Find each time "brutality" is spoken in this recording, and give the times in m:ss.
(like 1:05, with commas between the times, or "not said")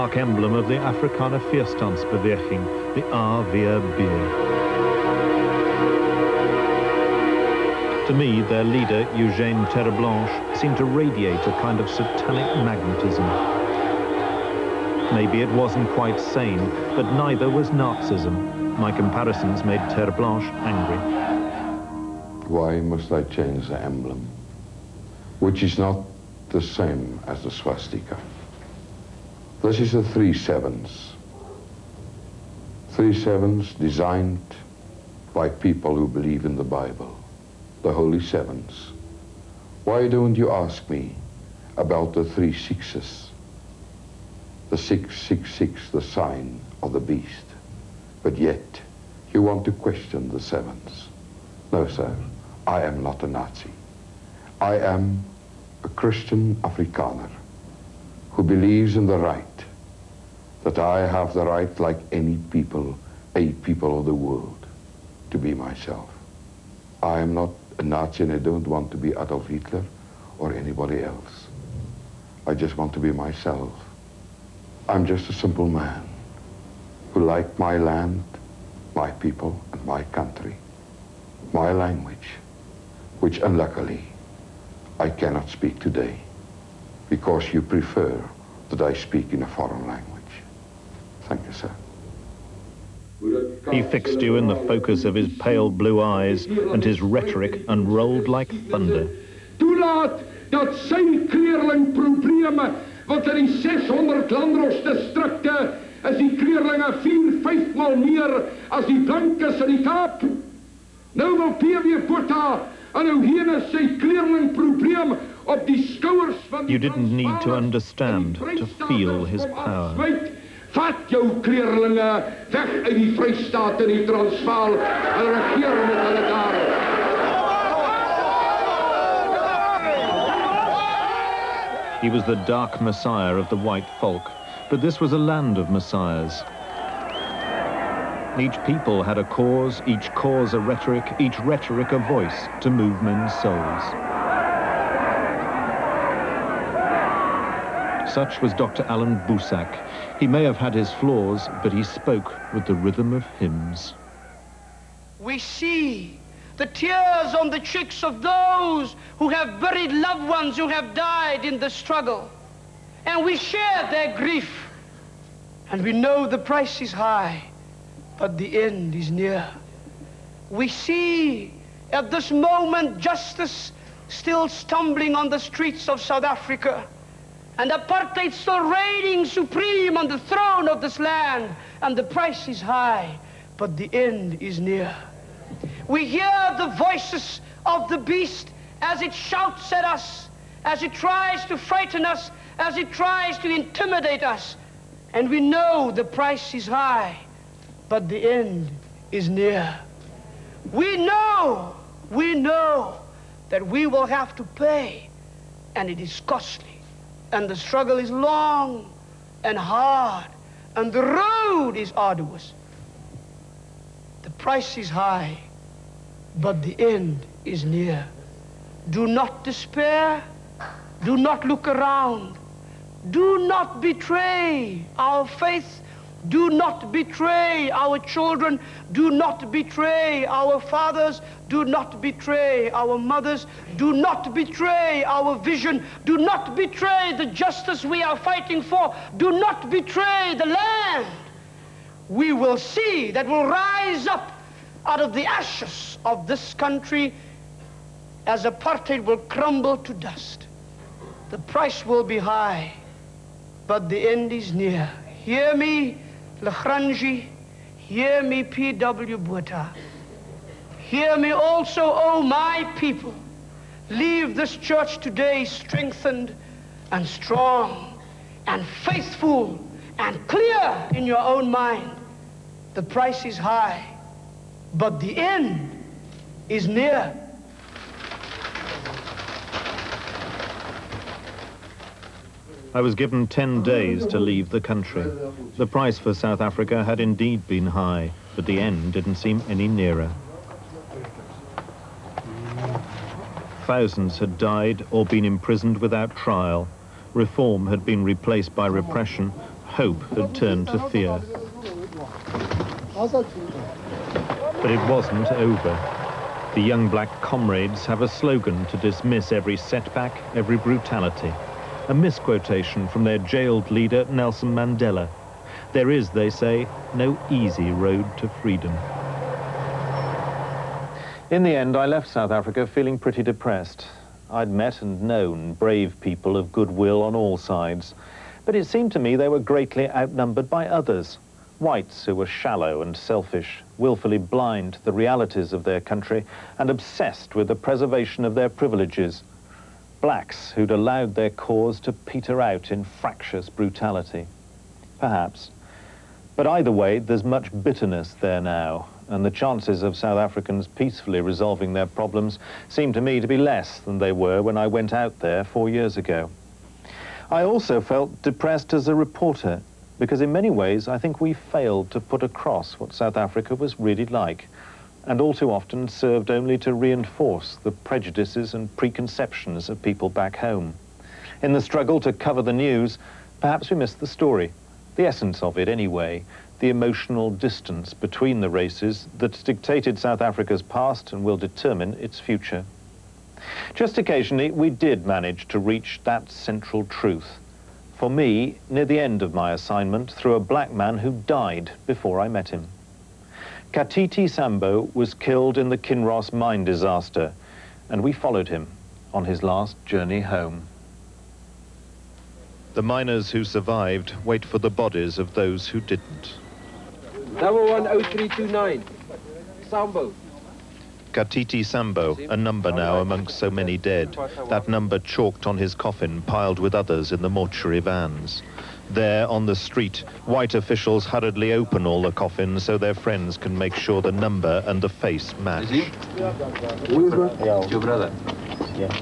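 5:10, 5:43.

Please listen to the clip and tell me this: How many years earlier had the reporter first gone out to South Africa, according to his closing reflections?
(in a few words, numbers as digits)
4.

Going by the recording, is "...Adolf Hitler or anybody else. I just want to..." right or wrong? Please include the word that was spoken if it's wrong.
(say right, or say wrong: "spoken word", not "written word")
right.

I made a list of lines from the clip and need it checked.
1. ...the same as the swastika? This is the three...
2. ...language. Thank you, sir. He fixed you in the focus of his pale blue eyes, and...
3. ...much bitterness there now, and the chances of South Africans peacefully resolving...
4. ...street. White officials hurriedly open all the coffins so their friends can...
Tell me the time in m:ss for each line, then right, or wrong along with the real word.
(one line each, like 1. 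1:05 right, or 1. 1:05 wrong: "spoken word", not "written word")
1. 0:26 right
2. 1:29 right
3. 5:47 right
4. 6:59 right.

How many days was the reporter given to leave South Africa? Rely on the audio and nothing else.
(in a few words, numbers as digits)
10.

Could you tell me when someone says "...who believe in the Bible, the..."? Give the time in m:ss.
0:35.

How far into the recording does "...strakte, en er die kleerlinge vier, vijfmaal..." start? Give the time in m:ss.
1:45.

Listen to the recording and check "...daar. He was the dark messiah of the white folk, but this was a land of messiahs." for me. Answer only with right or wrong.
right.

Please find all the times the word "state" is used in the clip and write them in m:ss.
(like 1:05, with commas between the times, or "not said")
not said.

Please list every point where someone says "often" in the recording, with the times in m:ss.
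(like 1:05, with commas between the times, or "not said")
6:05.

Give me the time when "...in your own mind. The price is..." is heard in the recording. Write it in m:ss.
4:30.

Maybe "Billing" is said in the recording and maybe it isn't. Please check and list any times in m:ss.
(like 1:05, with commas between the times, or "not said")
not said.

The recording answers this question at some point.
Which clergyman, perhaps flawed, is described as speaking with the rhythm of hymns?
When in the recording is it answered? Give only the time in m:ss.
2:28.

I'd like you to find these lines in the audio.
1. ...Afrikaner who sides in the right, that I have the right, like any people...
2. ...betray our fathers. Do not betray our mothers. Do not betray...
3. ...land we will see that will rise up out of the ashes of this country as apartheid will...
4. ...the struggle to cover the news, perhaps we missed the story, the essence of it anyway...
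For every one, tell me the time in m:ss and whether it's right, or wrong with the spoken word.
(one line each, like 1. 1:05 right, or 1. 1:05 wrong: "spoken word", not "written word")
1. 0:56 wrong: "believes", not "sides"
2. 3:49 right
3. 4:00 right
4. 6:11 right.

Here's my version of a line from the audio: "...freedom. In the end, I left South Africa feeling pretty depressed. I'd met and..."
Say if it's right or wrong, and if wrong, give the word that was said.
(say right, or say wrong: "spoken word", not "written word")
right.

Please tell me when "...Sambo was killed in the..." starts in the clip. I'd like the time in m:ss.
6:34.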